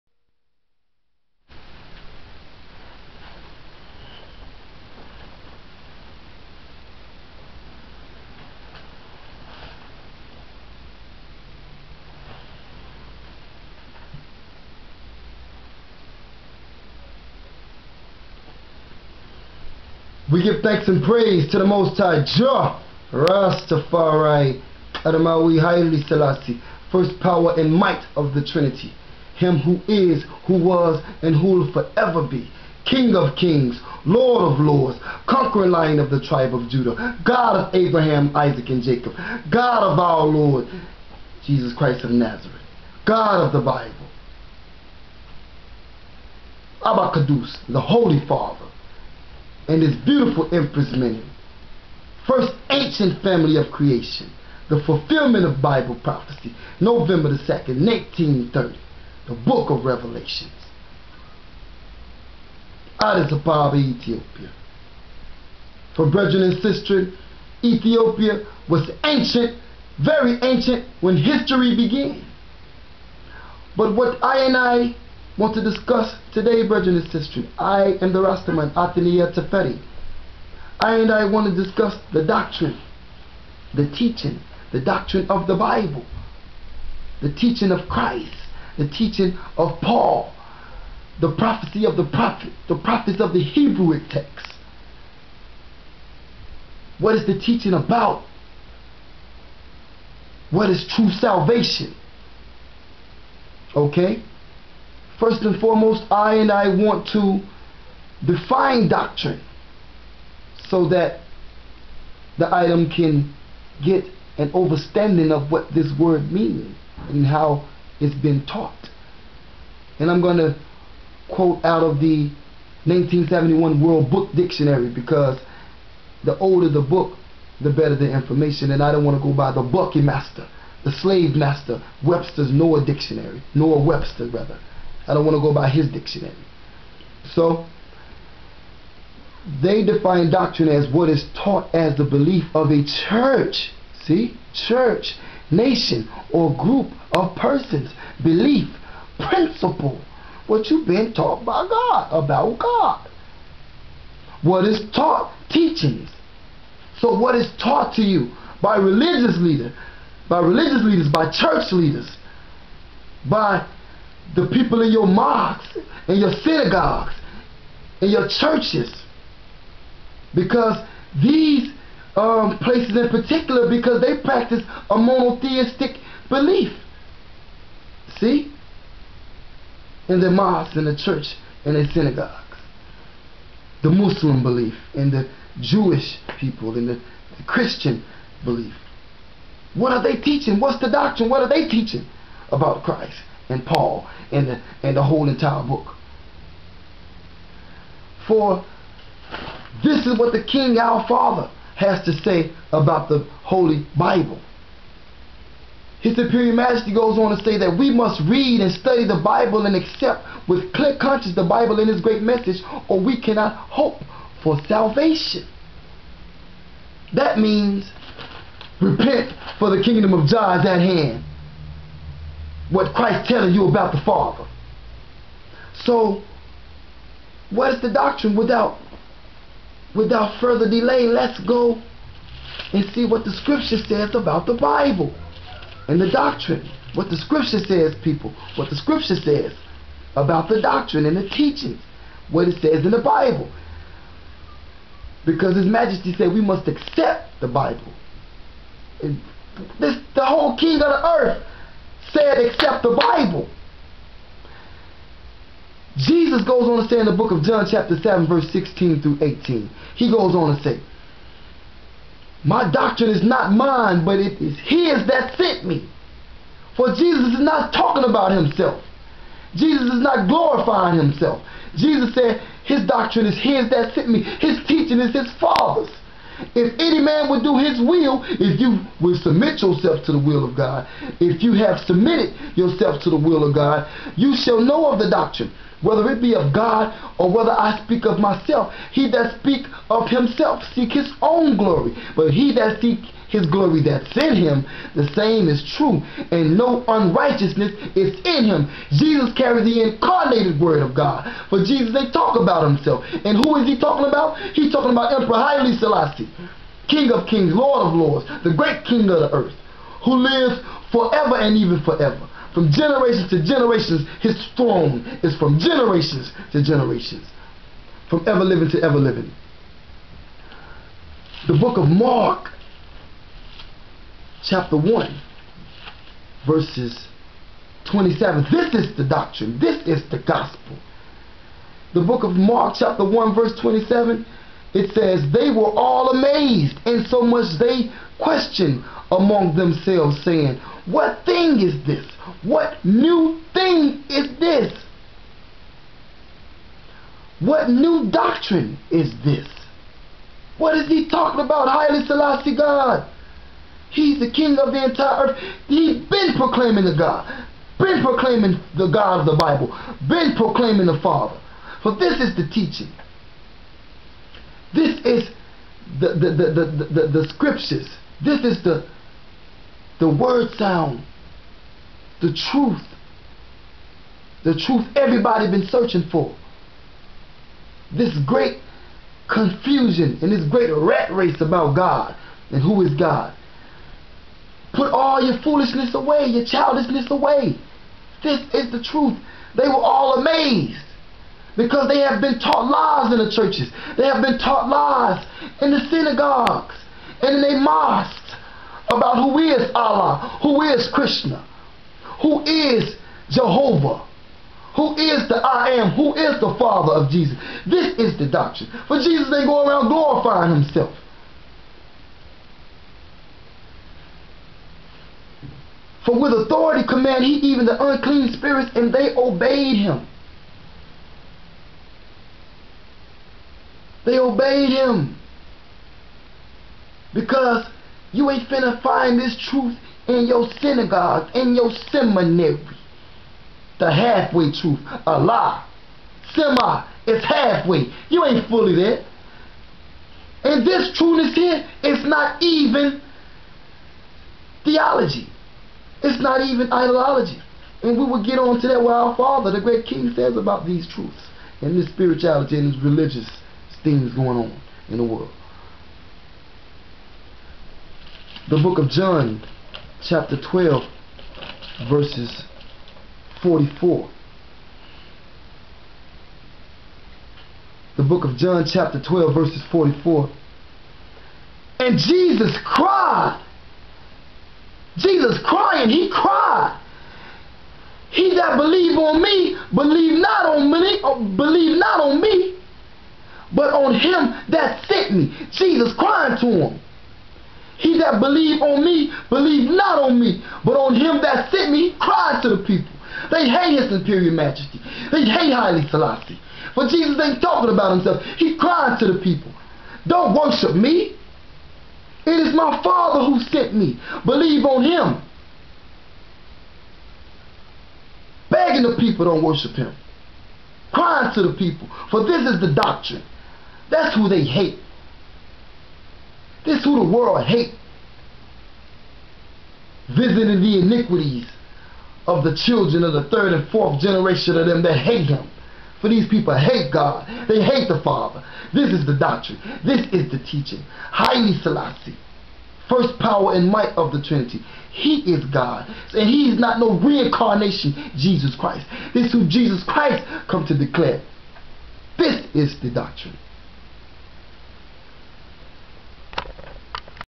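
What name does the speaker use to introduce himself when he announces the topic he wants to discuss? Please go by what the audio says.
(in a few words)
Othinel Tafari.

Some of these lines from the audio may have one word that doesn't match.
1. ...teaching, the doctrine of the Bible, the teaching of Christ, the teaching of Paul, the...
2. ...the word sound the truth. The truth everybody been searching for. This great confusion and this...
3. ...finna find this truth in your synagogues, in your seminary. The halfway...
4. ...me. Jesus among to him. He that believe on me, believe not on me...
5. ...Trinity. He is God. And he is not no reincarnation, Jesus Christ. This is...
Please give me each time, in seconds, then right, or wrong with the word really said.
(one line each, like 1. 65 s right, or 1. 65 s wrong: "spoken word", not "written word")
1. 83 s right
2. 369 s right
3. 428 s right
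4. 485 s wrong: "crying", not "among"
5. 534 s right.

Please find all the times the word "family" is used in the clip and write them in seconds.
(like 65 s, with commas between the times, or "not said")
53 s.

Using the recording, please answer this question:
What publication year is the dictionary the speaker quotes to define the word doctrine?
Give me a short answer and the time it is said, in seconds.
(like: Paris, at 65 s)
1971, at 122 s.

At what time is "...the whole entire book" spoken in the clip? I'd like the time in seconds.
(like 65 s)
194 s.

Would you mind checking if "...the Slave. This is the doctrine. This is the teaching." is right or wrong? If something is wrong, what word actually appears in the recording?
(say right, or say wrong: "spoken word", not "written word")
wrong: "Father", not "Slave".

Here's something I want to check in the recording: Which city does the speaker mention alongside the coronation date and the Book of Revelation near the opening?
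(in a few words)
Addis Ababa.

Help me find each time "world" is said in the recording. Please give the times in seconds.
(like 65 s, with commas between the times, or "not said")
123 s, 455 s, 517 s.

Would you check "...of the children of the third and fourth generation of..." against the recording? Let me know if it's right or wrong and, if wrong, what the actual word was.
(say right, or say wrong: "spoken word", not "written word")
right.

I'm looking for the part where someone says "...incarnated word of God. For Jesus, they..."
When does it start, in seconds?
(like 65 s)
299 s.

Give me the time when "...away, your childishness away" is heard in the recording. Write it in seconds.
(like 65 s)
385 s.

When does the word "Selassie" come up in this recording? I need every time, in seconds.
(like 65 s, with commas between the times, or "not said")
26 s, 305 s, 352 s, 495 s, 531 s.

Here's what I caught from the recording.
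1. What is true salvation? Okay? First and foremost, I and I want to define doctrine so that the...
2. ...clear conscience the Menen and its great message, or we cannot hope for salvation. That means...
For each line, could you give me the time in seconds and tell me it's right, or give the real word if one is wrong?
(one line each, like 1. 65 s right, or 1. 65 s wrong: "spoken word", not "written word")
1. 100 s right
2. 210 s wrong: "Bible", not "Menen".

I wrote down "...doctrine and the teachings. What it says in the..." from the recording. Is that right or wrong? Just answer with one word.
right.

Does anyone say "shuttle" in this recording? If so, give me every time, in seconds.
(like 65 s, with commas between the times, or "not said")
not said.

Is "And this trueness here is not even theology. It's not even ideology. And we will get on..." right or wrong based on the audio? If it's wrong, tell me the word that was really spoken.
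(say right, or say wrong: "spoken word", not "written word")
right.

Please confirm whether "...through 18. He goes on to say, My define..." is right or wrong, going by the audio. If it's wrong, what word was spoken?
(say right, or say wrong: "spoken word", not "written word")
wrong: "doctrine", not "define".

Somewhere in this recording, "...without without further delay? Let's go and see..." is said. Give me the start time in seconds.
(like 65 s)
228 s.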